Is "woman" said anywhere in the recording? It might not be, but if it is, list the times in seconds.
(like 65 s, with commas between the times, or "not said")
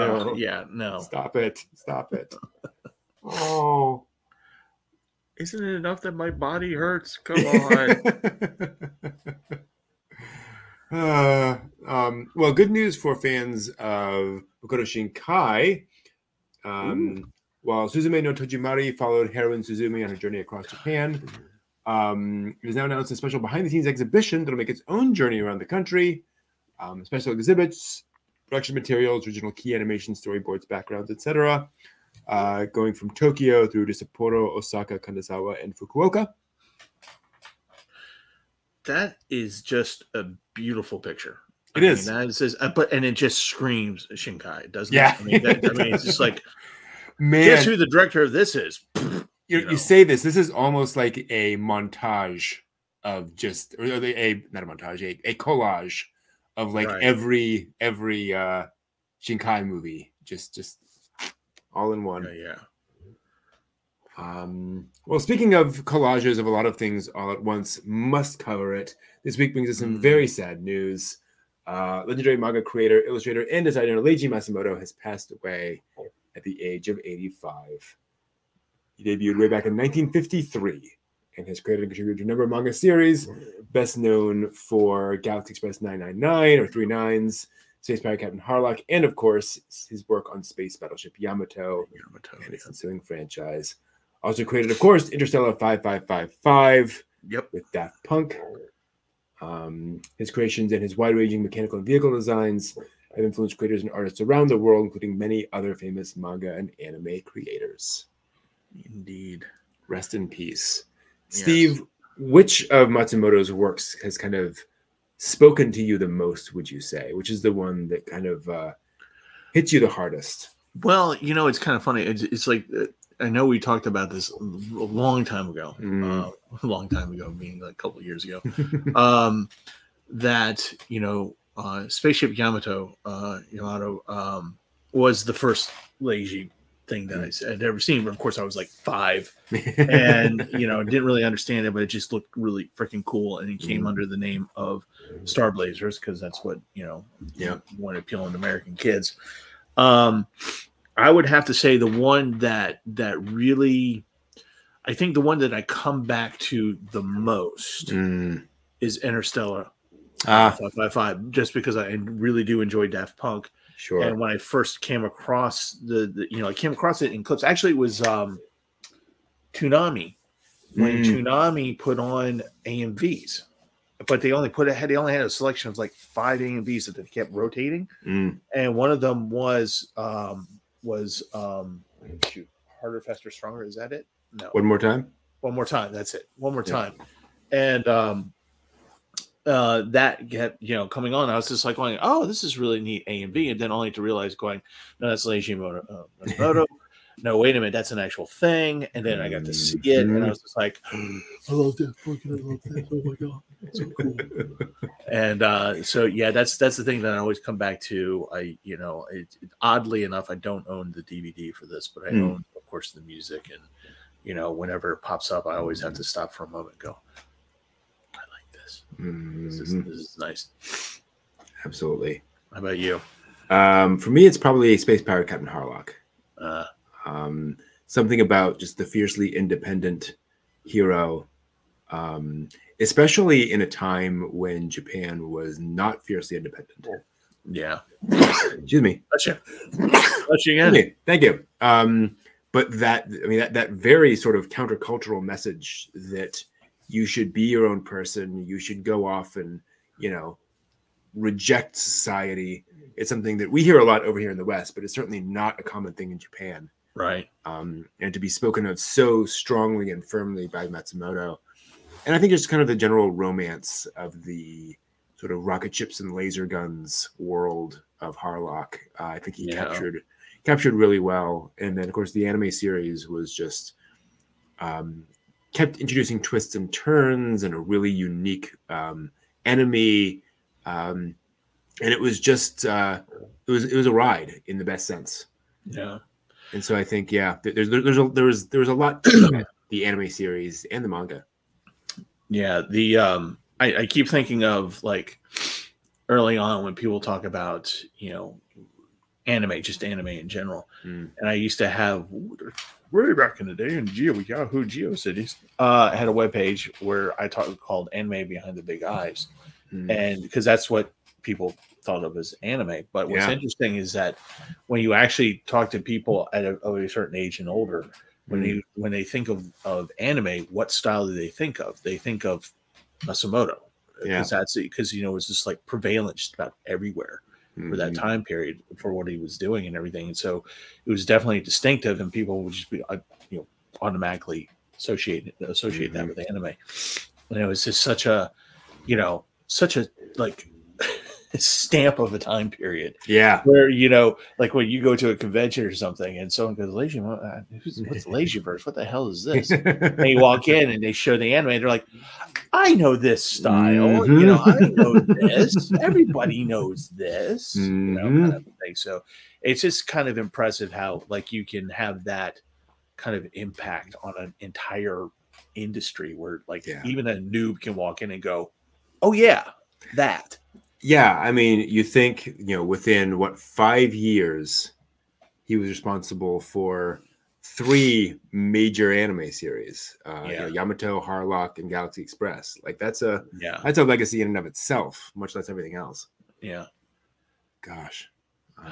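not said.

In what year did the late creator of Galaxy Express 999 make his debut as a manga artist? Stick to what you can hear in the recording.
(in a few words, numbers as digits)
1953.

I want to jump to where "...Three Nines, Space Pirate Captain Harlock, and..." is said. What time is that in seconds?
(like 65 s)
86 s.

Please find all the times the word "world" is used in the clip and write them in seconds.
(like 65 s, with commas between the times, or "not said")
104 s, 267 s.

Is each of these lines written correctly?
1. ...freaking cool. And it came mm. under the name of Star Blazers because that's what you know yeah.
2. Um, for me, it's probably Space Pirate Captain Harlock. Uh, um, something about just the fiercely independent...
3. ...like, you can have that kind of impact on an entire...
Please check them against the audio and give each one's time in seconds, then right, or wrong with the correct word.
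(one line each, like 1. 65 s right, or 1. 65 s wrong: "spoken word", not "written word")
1. 142 s right
2. 223 s right
3. 361 s right.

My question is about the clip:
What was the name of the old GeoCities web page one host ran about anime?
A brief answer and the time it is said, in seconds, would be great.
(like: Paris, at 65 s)
Anime Behind the Big Eyes, at 307 s.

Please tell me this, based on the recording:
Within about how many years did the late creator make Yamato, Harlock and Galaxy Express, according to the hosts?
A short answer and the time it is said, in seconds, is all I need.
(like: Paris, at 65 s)
5 years, at 373 s.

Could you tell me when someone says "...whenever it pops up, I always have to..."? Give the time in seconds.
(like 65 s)
214 s.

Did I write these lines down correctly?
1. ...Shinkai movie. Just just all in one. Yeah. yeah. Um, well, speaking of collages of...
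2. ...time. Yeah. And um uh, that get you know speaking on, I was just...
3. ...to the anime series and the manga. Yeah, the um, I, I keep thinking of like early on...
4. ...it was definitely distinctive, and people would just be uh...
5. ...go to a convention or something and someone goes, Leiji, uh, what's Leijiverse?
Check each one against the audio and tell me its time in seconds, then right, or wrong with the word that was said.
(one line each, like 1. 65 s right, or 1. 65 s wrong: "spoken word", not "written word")
1. 59 s right
2. 186 s wrong: "coming", not "speaking"
3. 289 s right
4. 330 s right
5. 344 s right.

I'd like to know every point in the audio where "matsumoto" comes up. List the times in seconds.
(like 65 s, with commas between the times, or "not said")
74 s, 112 s, 260 s, 323 s.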